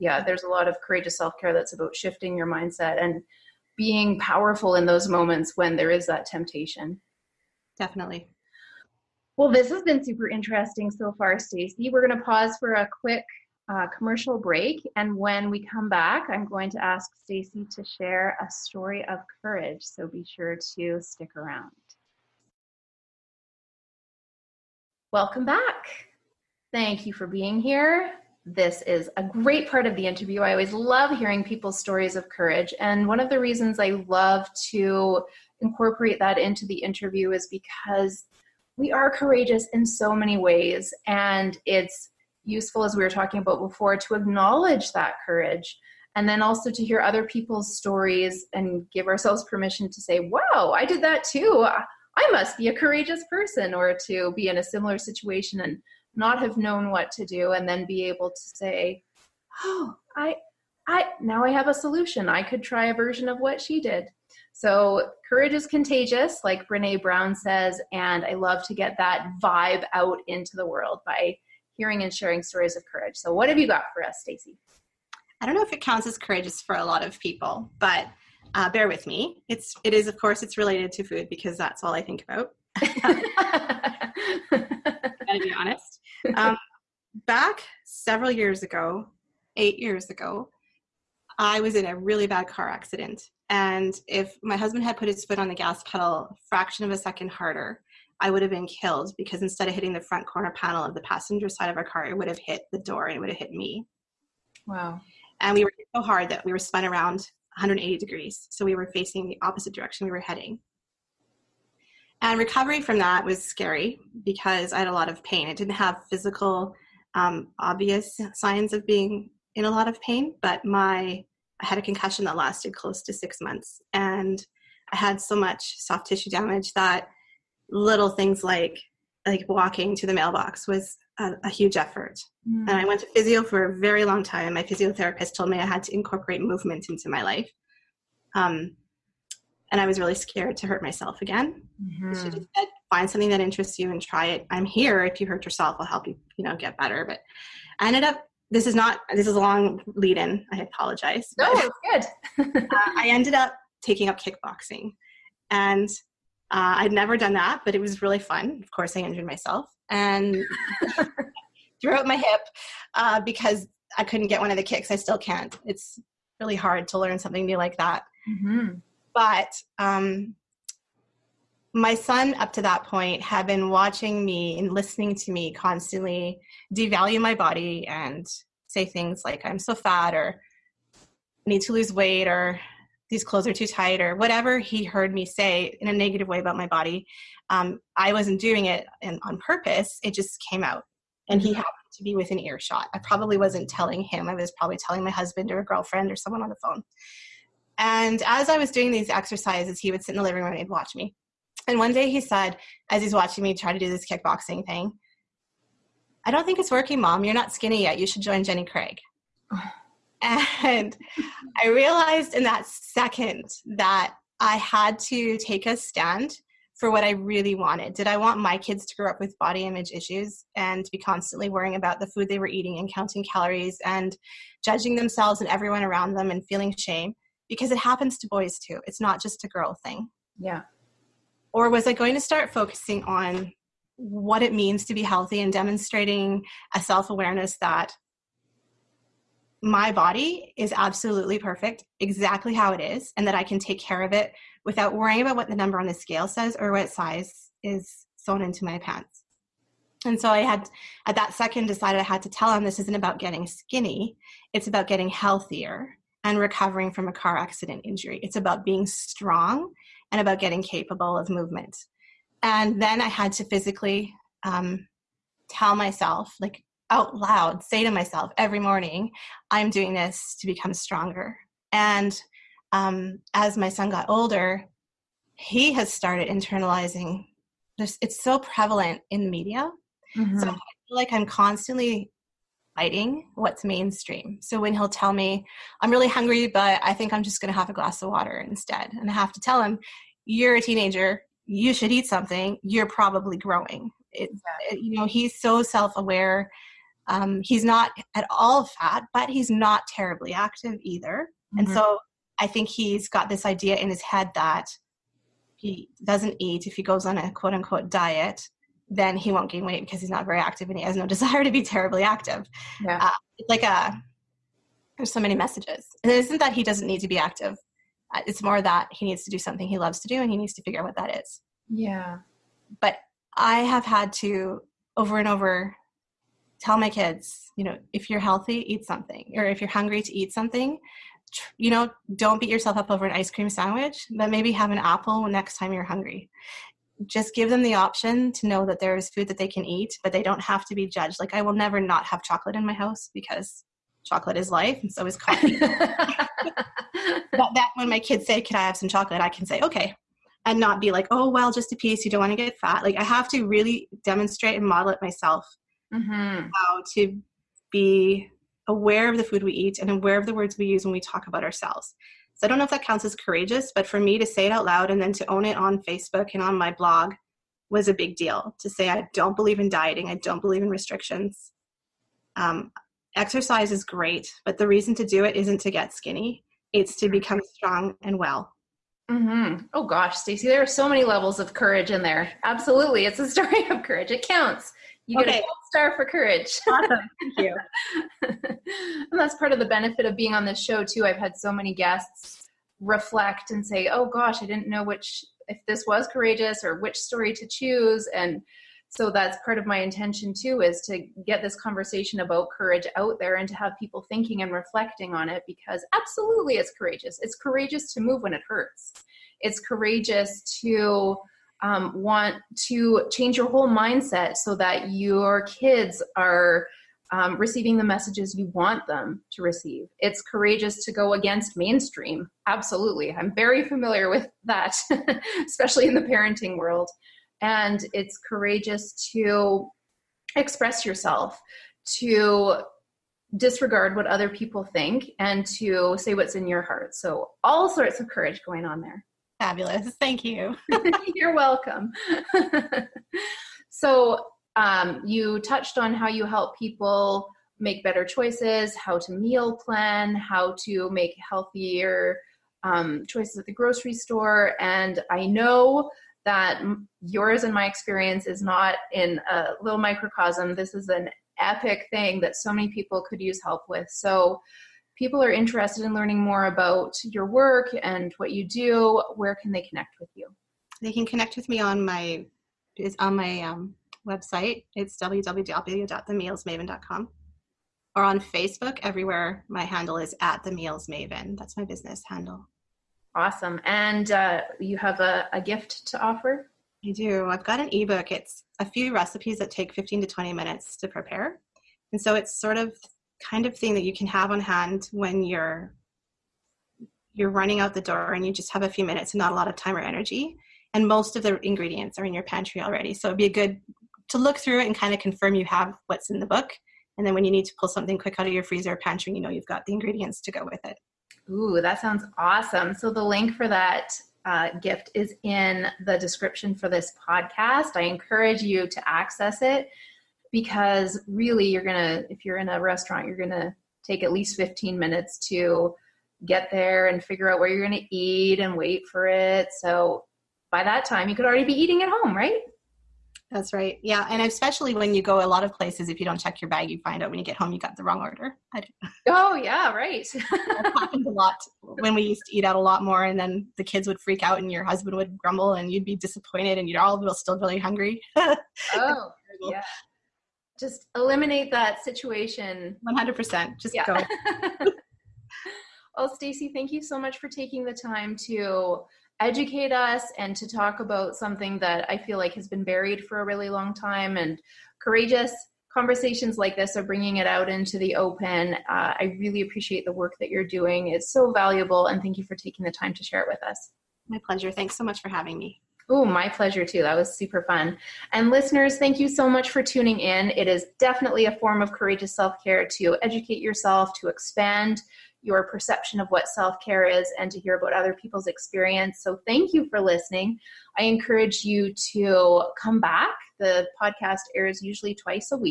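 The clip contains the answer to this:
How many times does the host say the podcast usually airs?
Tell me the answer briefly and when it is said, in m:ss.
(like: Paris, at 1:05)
Twice, at 9:54.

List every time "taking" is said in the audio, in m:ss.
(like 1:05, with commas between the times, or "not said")
2:33, 9:17, 9:32.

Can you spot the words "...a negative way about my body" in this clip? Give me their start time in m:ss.
3:05.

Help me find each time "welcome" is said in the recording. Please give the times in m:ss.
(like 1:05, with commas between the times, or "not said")
0:25, 7:21.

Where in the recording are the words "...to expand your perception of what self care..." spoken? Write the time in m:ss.
9:44.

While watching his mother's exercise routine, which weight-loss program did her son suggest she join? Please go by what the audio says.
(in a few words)
Jenny Craig.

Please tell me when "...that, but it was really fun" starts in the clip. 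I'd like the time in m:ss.
2:37.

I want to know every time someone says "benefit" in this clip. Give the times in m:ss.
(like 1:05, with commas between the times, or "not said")
6:29.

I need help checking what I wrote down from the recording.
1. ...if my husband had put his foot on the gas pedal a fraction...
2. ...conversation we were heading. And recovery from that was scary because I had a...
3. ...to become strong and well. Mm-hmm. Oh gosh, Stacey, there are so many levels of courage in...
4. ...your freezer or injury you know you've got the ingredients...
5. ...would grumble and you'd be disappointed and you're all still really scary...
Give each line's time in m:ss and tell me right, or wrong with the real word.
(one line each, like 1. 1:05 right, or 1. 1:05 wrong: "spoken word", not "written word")
1. 1:34 right
2. 1:49 wrong: "direction", not "conversation"
3. 6:16 right
4. 8:28 wrong: "pantry", not "injury"
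5. 9:04 wrong: "hungry", not "scary".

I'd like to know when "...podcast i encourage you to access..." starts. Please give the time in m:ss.
8:37.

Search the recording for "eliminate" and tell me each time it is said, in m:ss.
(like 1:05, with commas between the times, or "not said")
9:10.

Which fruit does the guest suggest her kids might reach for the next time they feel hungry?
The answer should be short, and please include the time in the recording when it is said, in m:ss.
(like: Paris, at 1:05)
An apple, at 5:34.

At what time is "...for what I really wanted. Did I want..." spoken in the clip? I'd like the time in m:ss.
3:36.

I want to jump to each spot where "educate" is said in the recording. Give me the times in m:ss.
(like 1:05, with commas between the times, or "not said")
9:19, 9:43.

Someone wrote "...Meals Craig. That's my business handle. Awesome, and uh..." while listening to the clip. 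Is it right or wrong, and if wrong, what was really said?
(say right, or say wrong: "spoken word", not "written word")
wrong: "Maven", not "Craig".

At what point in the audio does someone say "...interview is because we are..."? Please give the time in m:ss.
0:36.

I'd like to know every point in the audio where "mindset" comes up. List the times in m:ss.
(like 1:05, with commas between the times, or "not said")
0:02, 6:53.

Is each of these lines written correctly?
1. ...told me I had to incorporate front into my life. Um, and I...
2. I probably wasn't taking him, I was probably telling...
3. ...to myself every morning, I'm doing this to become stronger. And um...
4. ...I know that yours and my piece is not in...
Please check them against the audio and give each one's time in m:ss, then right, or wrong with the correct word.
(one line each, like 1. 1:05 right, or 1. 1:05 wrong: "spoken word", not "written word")
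1. 2:15 wrong: "movement", not "front"
2. 3:12 wrong: "telling", not "taking"
3. 4:27 right
4. 7:35 wrong: "experience", not "piece".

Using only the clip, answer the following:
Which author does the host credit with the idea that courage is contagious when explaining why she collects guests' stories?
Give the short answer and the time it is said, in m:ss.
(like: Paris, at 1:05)
Brene Brown, at 1:06.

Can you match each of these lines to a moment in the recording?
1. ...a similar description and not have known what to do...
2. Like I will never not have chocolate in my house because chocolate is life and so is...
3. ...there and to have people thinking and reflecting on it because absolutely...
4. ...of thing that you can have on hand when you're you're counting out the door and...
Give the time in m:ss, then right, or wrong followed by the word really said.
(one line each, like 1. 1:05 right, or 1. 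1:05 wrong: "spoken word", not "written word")
1. 0:54 wrong: "situation", not "description"
2. 5:41 right
3. 6:43 right
4. 8:13 wrong: "running", not "counting".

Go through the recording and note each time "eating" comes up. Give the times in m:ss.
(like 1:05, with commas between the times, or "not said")
3:42, 8:51.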